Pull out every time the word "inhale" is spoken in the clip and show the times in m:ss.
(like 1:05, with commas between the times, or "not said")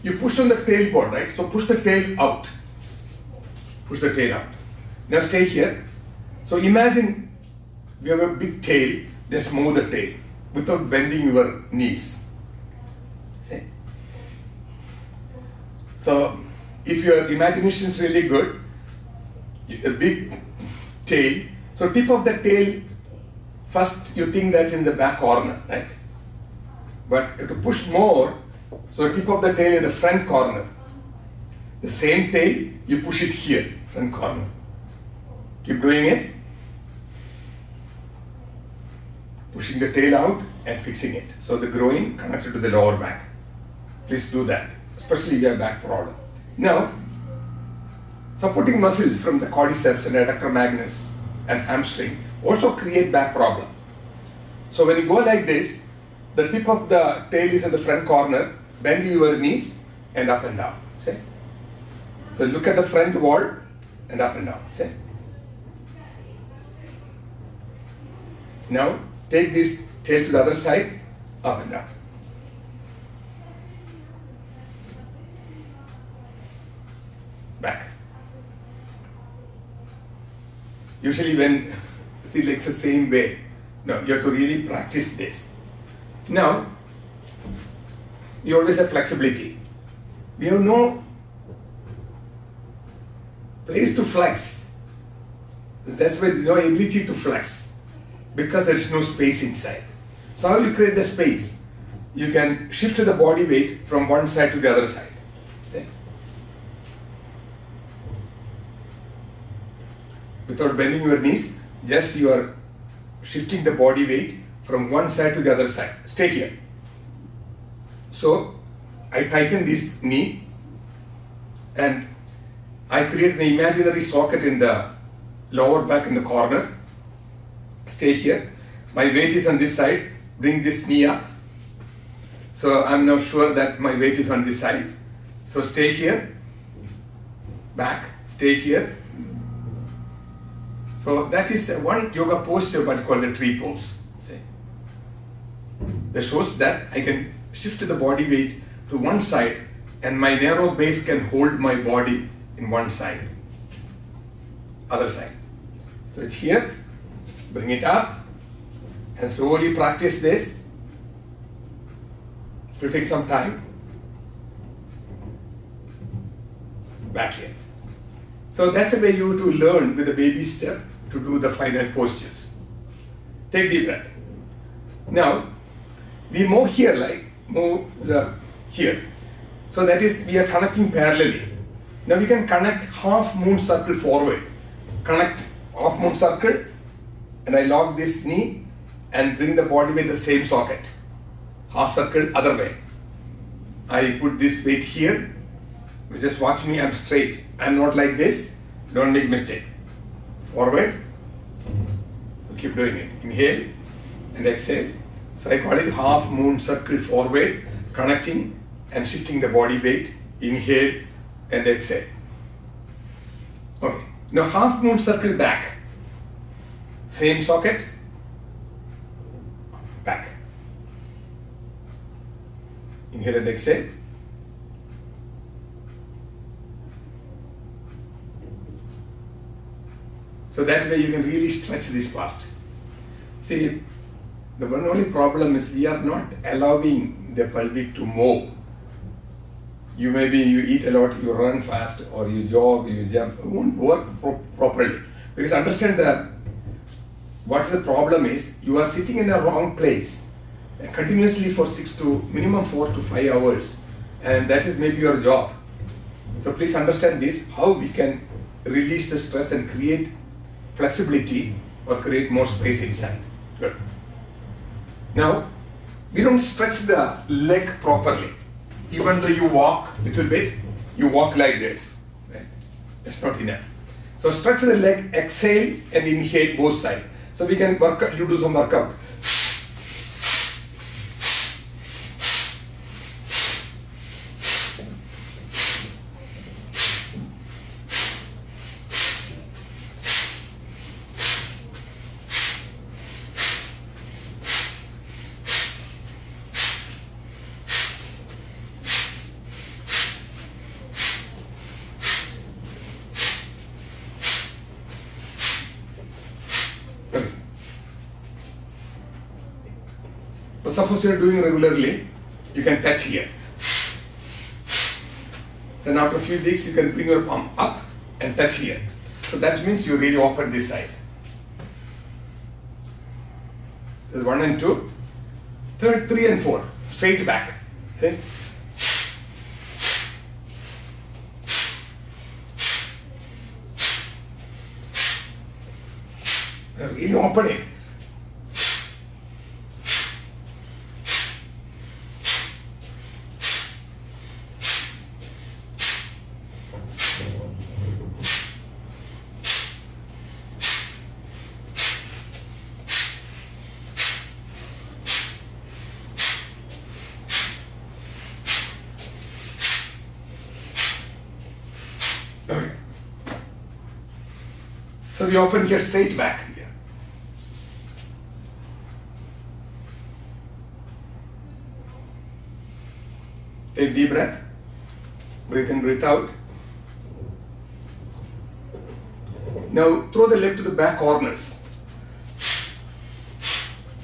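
3:23, 3:30, 3:43, 4:36.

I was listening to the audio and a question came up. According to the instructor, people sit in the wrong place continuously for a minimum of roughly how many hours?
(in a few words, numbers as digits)
4 to 5 hours.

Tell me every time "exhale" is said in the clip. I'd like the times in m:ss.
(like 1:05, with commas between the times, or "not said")
3:24, 3:31, 3:43, 4:35.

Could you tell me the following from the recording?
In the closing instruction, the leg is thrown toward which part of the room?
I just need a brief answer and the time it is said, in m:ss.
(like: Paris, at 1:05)
Back corners, at 6:20.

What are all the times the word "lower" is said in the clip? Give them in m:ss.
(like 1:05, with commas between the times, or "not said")
0:42, 2:05.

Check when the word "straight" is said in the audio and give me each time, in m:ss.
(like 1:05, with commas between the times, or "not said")
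3:16, 5:26, 6:05.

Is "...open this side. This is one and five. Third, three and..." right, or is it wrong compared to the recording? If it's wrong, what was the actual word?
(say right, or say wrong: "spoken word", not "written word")
wrong: "two", not "five".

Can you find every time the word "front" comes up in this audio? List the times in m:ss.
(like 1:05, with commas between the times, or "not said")
0:29, 0:33, 0:57, 1:02.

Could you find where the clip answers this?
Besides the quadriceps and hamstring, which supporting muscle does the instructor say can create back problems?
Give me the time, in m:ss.
0:50.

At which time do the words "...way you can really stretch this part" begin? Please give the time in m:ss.
3:50.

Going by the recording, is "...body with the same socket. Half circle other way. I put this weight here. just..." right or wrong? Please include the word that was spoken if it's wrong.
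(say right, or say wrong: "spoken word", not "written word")
right.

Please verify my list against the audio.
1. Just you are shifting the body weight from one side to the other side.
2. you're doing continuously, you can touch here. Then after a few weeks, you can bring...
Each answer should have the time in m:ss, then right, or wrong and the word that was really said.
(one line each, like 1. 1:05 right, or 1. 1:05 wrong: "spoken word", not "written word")
1. 1:51 right
2. 5:11 wrong: "regularly", not "continuously".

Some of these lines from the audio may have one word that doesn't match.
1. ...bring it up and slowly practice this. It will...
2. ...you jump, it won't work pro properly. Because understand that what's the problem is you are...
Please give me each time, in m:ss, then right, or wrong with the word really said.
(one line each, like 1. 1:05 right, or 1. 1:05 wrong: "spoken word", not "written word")
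1. 2:37 right
2. 4:02 right.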